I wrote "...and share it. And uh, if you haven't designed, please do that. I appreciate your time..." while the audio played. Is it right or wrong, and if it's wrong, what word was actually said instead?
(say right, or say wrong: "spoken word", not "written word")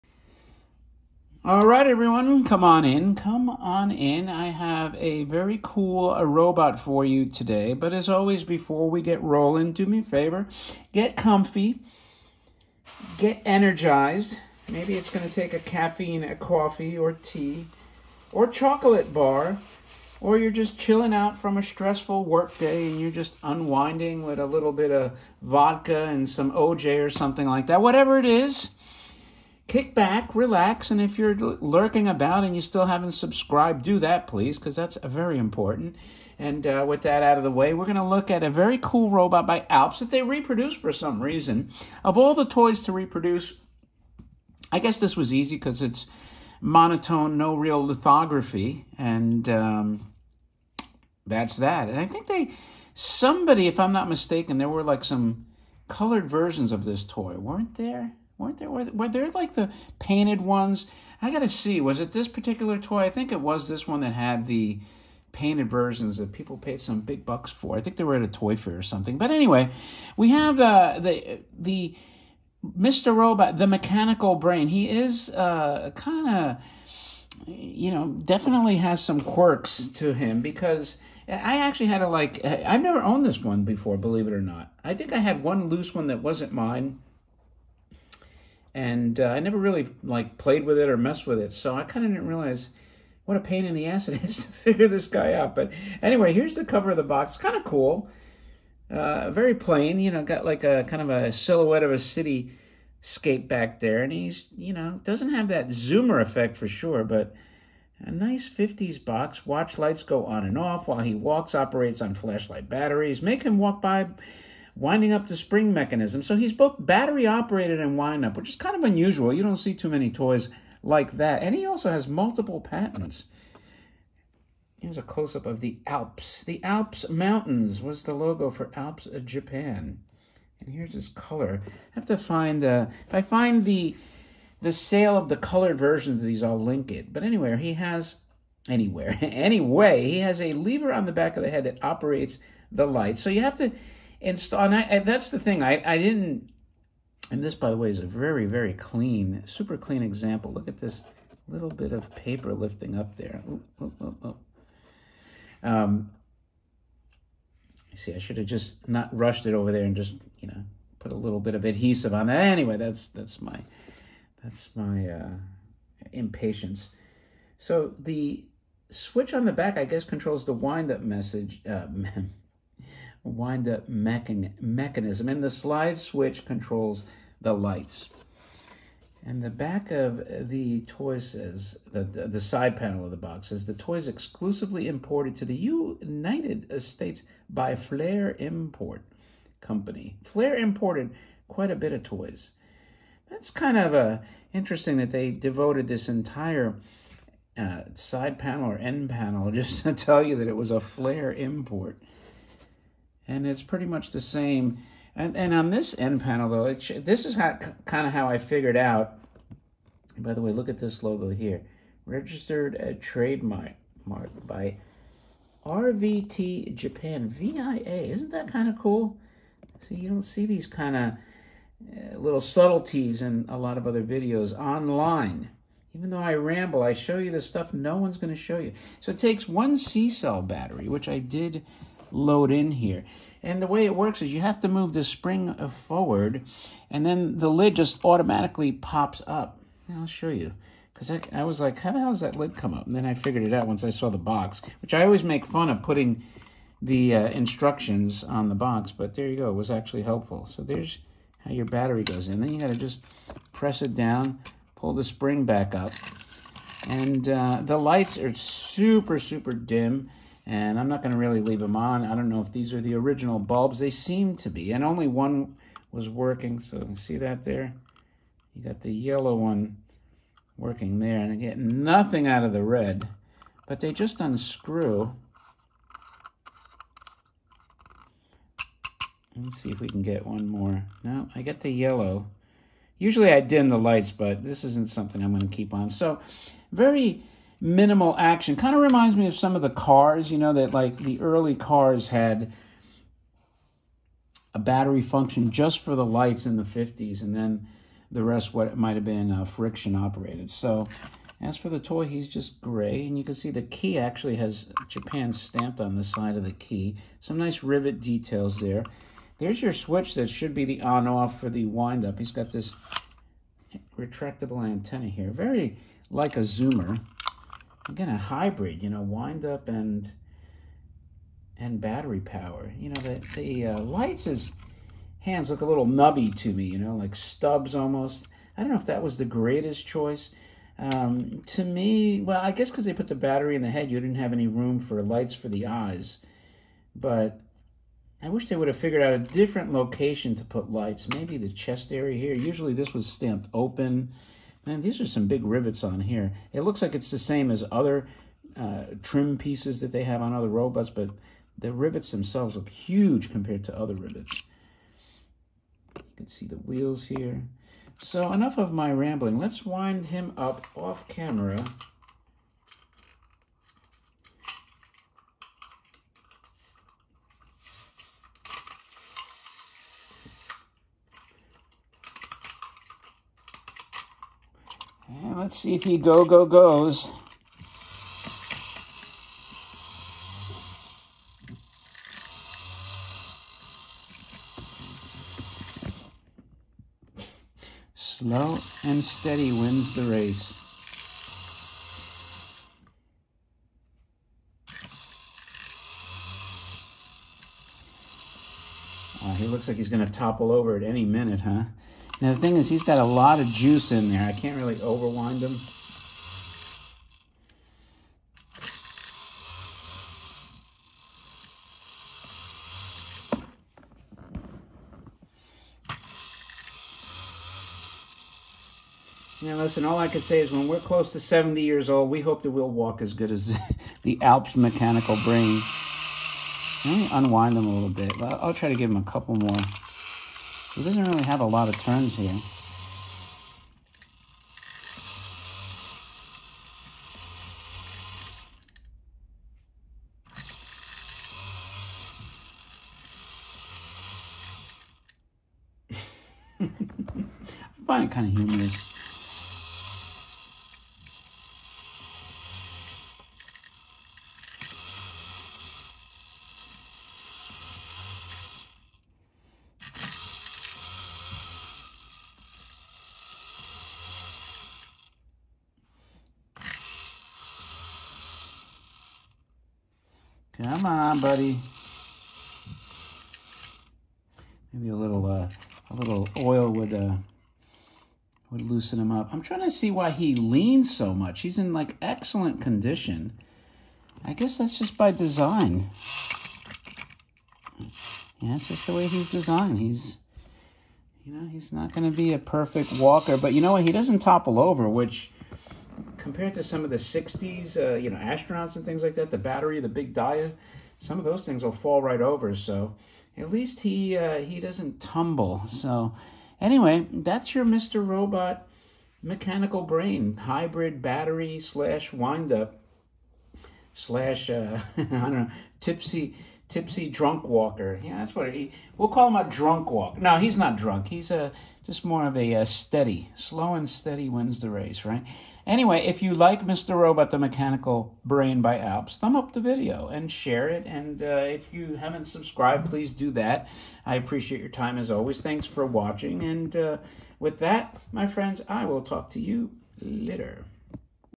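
wrong: "subscribed", not "designed".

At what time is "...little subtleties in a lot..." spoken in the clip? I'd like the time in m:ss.
3:42.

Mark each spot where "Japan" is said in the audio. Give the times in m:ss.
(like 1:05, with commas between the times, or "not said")
2:09, 3:36, 5:04.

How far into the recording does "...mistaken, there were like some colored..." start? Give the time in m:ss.
0:54.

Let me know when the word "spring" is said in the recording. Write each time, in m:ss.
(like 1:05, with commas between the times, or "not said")
1:55, 3:55, 4:15.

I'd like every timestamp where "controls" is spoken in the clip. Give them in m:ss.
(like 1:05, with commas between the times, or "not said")
2:50, 2:56.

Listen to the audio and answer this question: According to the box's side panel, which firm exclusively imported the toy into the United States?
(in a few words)
Flair Import Company.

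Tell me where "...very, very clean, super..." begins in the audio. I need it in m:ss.
2:28.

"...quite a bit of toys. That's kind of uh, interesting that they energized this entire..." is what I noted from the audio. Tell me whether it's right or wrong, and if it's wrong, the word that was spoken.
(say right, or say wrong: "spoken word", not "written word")
wrong: "devoted", not "energized".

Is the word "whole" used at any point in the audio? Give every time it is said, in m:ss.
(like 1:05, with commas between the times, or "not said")
not said.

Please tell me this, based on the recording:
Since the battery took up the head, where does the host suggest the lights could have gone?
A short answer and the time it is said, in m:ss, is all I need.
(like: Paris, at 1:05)
the chest area, at 5:41.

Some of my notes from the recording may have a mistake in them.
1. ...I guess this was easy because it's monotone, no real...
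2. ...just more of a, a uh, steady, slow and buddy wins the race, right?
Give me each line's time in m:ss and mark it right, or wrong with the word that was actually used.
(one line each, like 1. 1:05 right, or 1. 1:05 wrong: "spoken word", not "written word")
1. 0:44 right
2. 8:41 wrong: "steady", not "buddy".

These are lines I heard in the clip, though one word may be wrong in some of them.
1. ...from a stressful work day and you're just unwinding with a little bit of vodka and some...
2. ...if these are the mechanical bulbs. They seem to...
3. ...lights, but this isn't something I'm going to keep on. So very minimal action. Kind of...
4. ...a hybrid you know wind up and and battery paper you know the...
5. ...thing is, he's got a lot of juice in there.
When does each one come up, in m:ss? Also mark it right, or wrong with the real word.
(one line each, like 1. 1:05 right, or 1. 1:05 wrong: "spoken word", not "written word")
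1. 0:21 right
2. 4:22 wrong: "original", not "mechanical"
3. 4:43 right
4. 5:18 wrong: "power", not "paper"
5. 6:42 right.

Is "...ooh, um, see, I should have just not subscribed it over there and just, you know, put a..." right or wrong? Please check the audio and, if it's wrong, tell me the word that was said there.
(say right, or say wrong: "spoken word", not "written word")
wrong: "rushed", not "subscribed".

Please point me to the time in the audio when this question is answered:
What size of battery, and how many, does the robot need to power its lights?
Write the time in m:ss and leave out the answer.
3:49.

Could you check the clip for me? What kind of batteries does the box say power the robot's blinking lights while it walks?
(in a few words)
flashlight batteries.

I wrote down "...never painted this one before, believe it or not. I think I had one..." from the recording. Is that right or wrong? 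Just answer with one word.
wrong.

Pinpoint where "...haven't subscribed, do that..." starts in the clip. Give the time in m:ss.
0:32.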